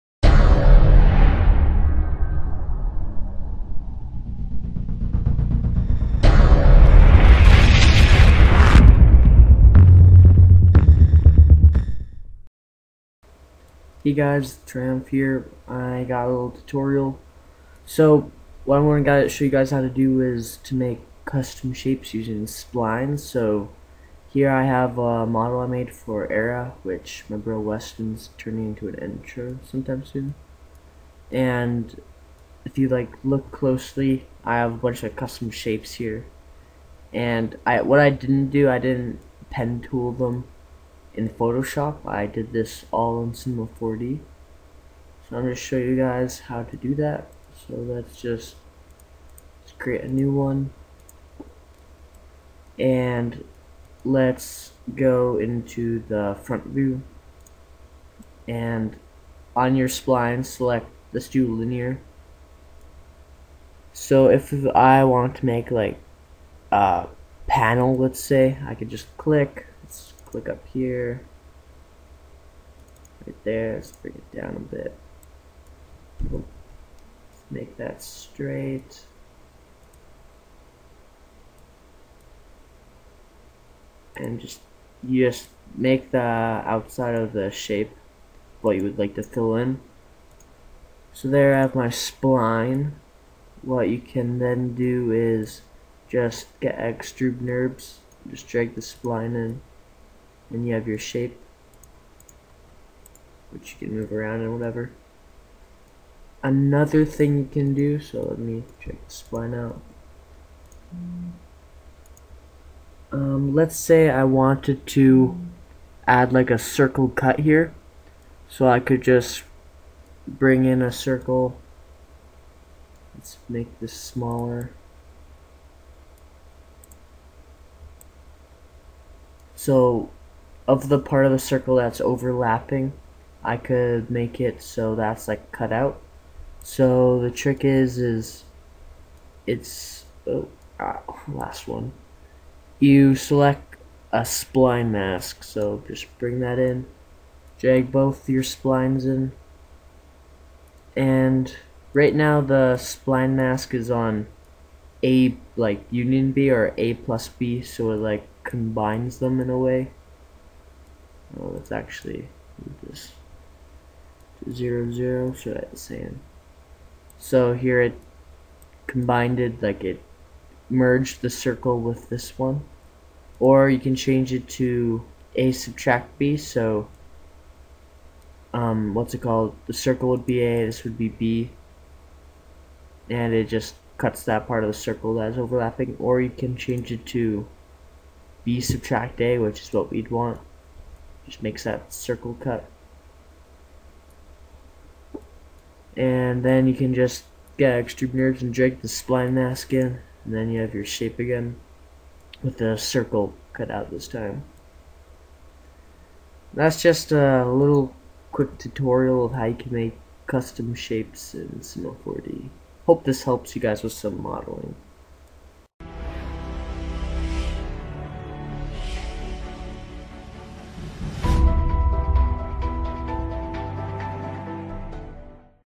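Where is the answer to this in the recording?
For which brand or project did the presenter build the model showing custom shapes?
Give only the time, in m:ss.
0:26.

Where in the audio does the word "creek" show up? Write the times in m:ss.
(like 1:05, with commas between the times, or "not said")
not said.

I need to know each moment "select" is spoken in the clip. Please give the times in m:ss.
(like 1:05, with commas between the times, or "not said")
1:00, 2:23.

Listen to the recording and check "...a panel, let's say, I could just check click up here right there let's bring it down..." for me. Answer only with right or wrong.
wrong.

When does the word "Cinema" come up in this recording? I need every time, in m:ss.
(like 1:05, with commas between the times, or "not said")
0:43, 3:31.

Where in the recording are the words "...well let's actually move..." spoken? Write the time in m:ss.
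2:41.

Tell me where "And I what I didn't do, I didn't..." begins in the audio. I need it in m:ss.
0:37.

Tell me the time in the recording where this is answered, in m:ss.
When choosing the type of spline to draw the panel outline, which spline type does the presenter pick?
1:01.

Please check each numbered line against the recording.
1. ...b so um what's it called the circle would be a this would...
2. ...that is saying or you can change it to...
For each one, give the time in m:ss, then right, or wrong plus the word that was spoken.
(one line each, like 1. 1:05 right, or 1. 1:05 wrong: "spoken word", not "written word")
1. 2:56 right
2. 3:05 wrong: "overlapping", not "saying".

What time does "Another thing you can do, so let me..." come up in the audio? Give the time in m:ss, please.
1:46.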